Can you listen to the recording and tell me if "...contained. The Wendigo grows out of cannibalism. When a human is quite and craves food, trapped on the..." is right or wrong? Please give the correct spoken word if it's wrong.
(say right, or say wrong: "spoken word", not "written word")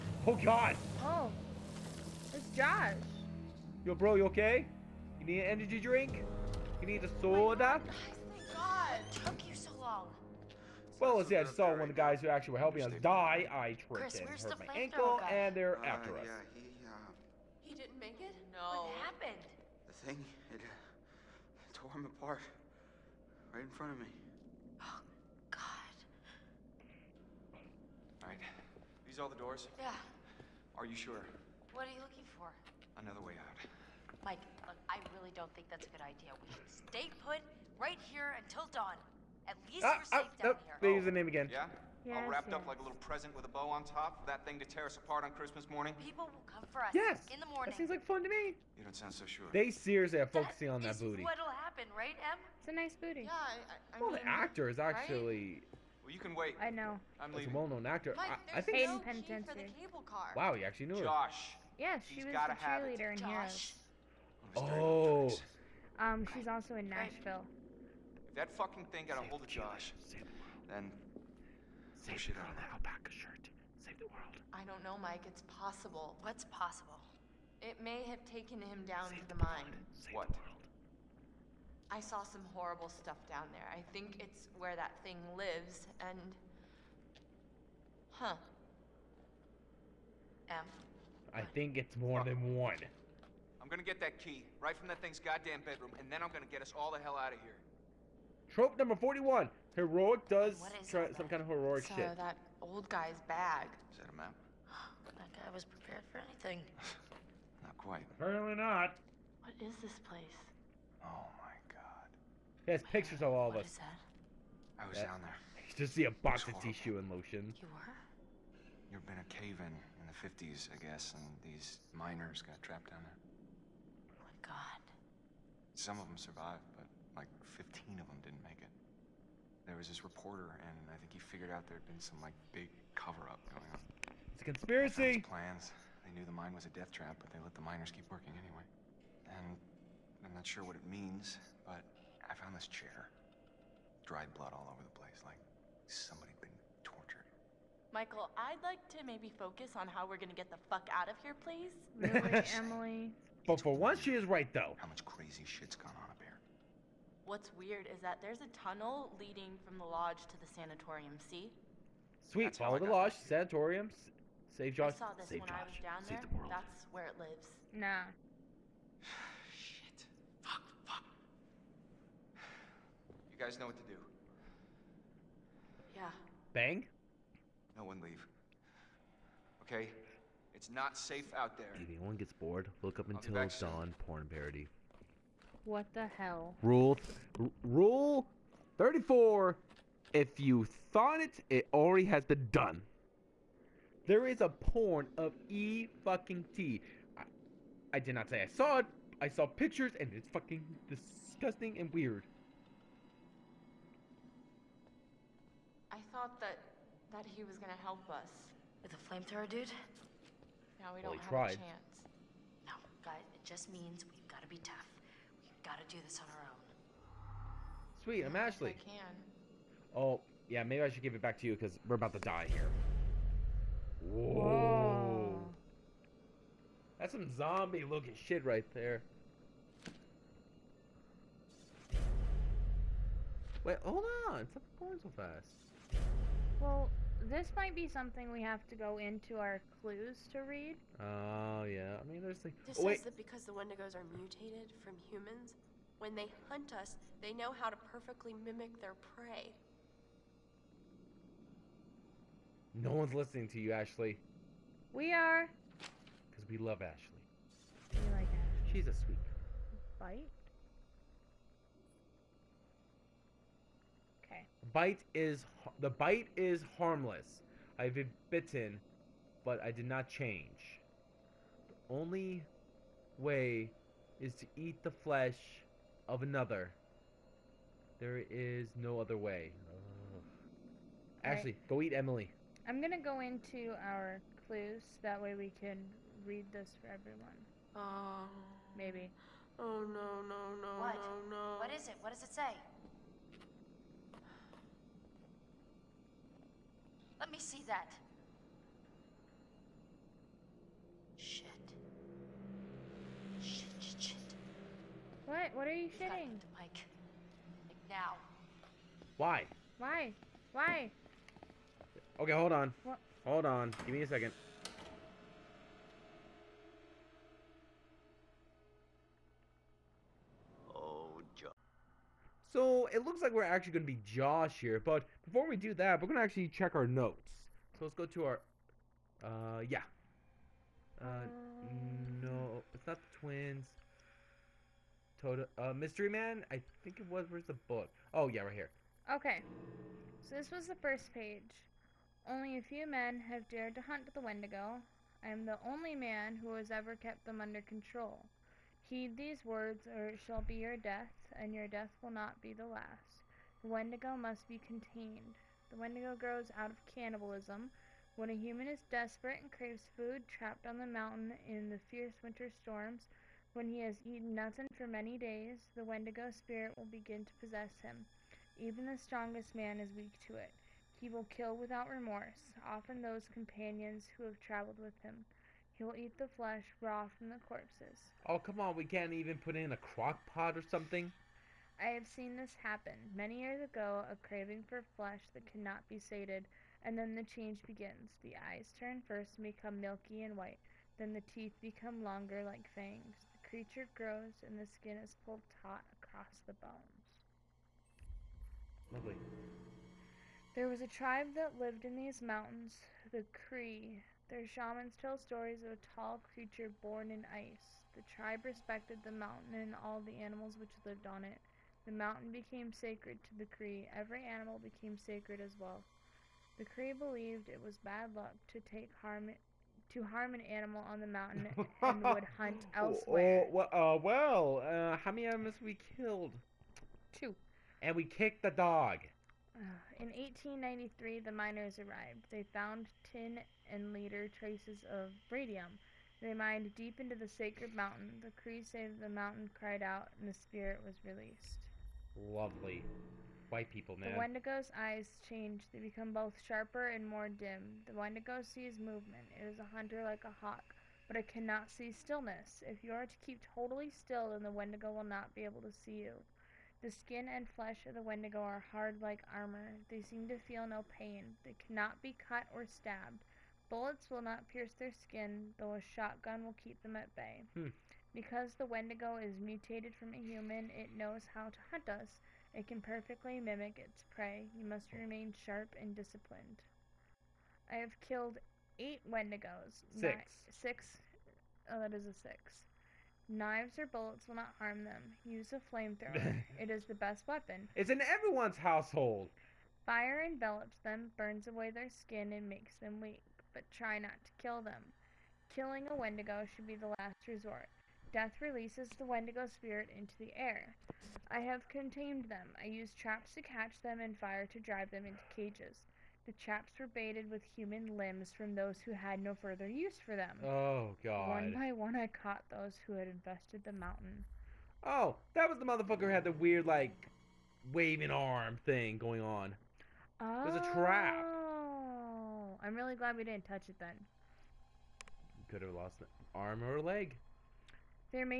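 wrong: "desperate", not "quite".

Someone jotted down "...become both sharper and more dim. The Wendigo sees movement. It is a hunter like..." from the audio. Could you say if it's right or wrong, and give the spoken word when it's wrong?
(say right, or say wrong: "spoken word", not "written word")
right.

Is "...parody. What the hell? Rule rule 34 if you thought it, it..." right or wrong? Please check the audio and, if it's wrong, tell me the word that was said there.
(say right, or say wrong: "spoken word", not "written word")
right.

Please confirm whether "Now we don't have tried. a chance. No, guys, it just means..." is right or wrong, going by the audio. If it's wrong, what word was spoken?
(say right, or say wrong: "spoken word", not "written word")
right.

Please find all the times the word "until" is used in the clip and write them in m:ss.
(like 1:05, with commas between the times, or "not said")
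0:38, 3:03.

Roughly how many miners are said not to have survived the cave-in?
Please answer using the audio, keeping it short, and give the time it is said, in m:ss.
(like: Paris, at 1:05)
15, at 2:07.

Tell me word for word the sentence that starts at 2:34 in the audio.
How much crazy shit's gone on up here?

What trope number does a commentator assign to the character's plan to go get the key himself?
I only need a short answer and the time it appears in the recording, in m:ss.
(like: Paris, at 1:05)
41, at 1:38.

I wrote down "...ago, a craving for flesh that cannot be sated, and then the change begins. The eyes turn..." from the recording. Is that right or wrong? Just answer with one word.
right.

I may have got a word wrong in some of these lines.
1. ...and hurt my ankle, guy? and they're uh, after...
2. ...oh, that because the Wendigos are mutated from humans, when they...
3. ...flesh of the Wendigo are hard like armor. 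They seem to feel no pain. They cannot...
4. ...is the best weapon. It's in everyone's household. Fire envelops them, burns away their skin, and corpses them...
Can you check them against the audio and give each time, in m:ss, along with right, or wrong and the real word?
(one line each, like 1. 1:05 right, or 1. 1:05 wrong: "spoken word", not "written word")
1. 0:14 right
2. 4:02 right
3. 7:37 right
4. 8:06 wrong: "makes", not "corpses".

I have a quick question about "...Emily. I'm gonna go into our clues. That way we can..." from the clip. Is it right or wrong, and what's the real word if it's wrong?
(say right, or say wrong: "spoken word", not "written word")
right.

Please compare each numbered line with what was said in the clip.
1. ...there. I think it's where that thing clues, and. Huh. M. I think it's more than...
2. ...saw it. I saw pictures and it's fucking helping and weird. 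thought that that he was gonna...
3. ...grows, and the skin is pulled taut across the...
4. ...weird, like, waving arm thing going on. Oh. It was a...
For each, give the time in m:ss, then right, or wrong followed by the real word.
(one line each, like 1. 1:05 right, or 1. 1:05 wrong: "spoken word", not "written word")
1. 1:23 wrong: "lives", not "clues"
2. 3:18 wrong: "disgusting", not "helping"
3. 6:33 right
4. 8:36 right.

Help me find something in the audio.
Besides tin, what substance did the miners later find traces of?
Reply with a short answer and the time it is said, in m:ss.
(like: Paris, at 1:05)
Radium, at 7:15.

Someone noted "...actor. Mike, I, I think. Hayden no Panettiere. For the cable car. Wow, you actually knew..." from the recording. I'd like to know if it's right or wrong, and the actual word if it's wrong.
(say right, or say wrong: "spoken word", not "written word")
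right.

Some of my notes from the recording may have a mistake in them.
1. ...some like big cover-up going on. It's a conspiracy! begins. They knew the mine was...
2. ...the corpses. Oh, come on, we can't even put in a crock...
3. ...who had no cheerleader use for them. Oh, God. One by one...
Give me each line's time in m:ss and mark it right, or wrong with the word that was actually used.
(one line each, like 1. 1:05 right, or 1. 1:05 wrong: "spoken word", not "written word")
1. 2:12 wrong: "plans", not "begins"
2. 6:17 right
3. 8:28 wrong: "further", not "cheerleader".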